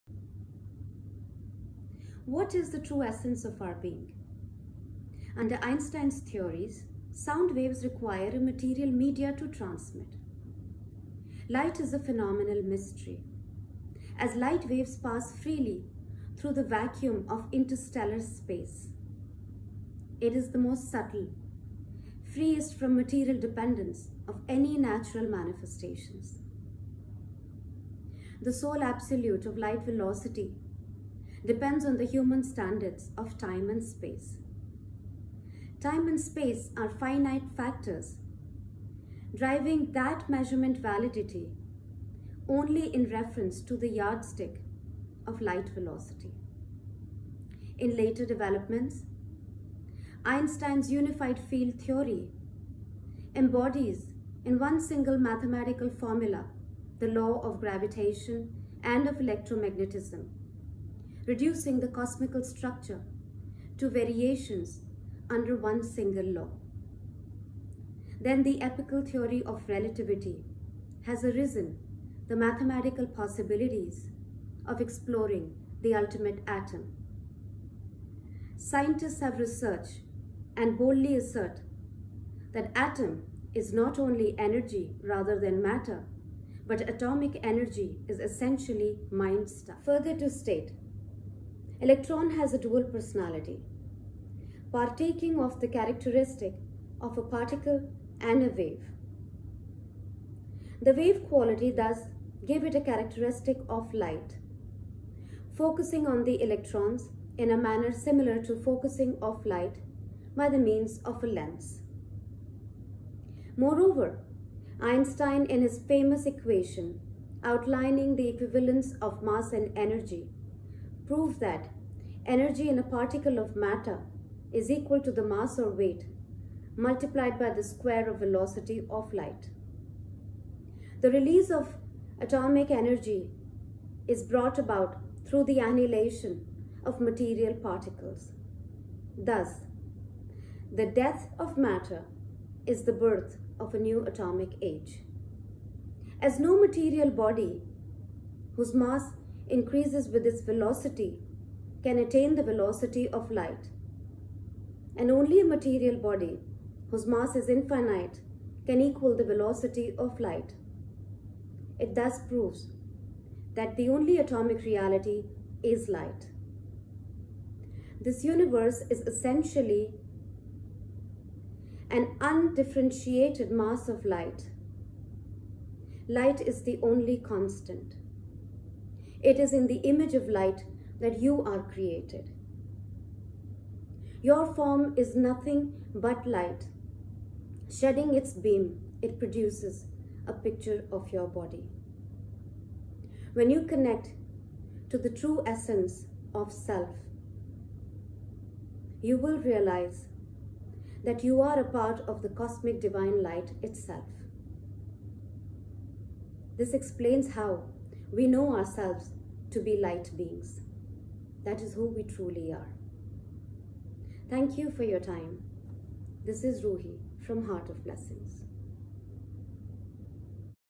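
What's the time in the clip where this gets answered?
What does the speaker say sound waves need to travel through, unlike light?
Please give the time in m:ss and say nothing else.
0:08.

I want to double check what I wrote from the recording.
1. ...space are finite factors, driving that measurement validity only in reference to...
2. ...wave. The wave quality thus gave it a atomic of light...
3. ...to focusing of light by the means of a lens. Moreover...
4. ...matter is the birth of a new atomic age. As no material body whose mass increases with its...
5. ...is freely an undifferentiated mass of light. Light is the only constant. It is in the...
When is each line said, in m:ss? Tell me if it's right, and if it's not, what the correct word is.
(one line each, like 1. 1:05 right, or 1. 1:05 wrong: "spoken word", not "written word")
1. 0:36 right
2. 1:38 wrong: "characteristic", not "atomic"
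3. 1:48 right
4. 2:21 right
5. 2:48 wrong: "essentially", not "freely".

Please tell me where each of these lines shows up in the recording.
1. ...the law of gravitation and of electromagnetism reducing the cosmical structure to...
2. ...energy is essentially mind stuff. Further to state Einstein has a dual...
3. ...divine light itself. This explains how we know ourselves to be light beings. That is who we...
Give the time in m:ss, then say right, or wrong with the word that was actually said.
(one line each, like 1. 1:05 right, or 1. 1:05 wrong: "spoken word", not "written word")
1. 0:56 right
2. 1:27 wrong: "Electron", not "Einstein"
3. 3:22 right.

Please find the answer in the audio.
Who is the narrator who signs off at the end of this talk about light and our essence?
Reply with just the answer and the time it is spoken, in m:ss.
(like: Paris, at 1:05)
Ruhi, at 3:36.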